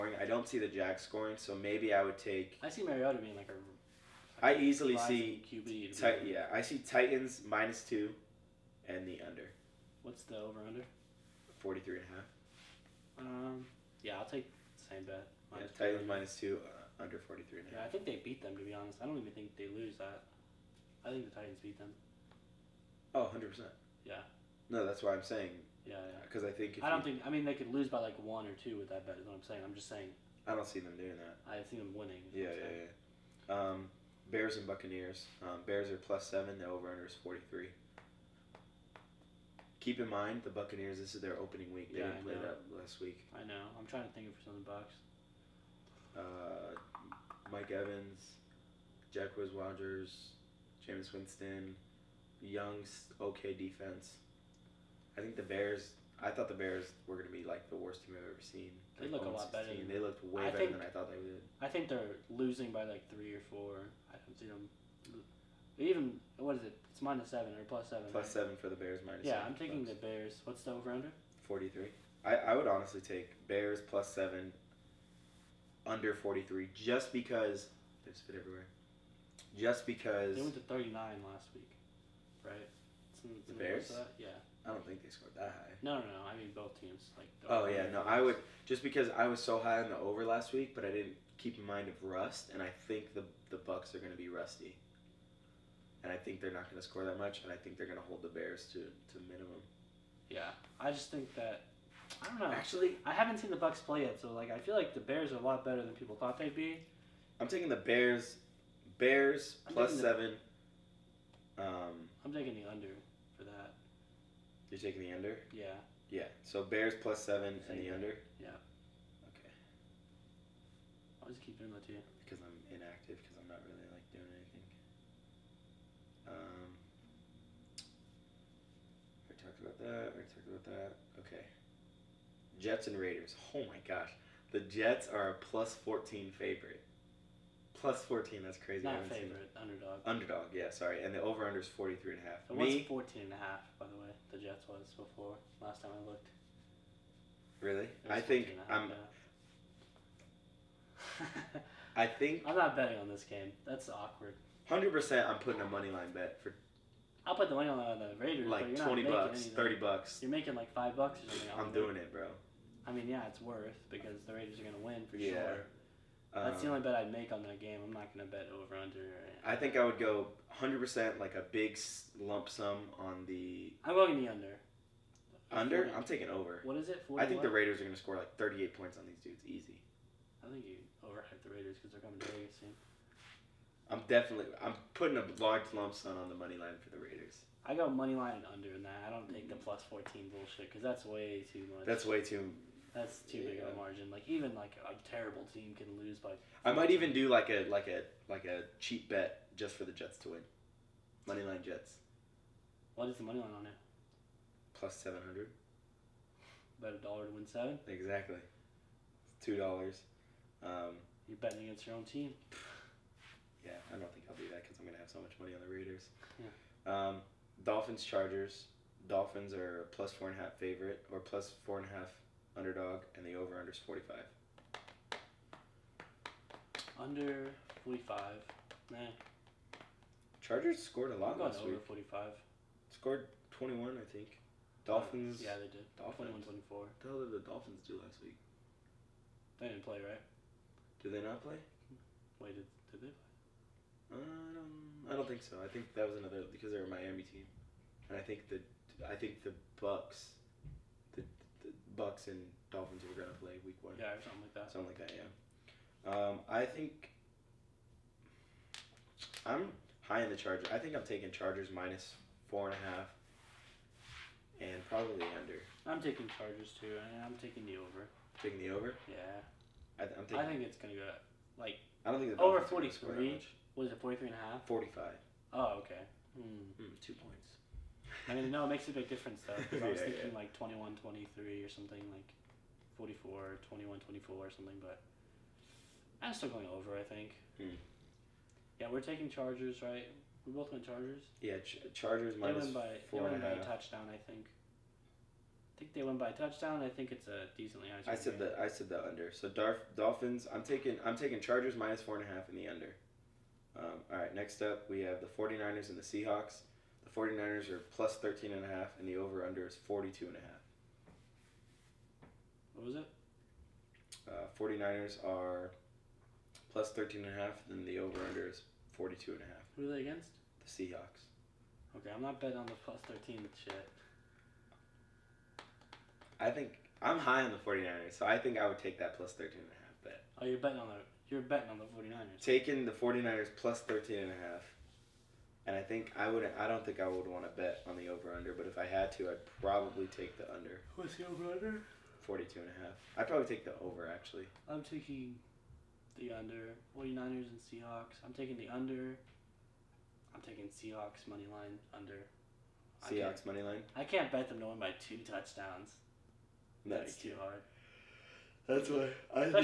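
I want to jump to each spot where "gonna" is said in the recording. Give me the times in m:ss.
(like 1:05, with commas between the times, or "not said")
3:34, 4:13, 4:30.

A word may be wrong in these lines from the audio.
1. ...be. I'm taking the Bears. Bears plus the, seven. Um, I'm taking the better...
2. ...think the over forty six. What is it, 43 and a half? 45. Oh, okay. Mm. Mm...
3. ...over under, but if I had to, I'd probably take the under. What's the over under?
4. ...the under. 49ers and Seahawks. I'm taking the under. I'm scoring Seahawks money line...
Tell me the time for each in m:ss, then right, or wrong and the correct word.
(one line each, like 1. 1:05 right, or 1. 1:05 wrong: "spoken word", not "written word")
1. 1:46 wrong: "under", not "better"
2. 4:32 wrong: "three", not "six"
3. 5:38 right
4. 5:46 wrong: "taking", not "scoring".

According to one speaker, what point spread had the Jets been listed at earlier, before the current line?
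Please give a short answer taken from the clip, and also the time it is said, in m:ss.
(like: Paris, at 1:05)
14.5, at 2:22.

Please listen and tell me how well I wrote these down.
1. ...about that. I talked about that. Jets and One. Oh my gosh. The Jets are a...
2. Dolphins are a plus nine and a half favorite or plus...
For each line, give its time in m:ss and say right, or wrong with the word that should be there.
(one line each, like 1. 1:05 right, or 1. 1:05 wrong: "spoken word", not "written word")
1. 2:09 wrong: "Raiders", not "One"
2. 3:39 wrong: "four", not "nine".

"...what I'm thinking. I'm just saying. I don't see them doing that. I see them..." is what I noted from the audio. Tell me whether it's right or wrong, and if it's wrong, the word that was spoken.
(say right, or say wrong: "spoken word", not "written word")
wrong: "saying", not "thinking".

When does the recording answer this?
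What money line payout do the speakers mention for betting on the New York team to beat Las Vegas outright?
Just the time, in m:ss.
3:24.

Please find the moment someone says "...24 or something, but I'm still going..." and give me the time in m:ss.
4:43.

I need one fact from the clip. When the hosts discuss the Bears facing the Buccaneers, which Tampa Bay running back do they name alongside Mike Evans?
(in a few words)
Jacquizz Rodgers.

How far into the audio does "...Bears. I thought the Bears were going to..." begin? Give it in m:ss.
0:55.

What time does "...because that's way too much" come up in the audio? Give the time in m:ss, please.
3:10.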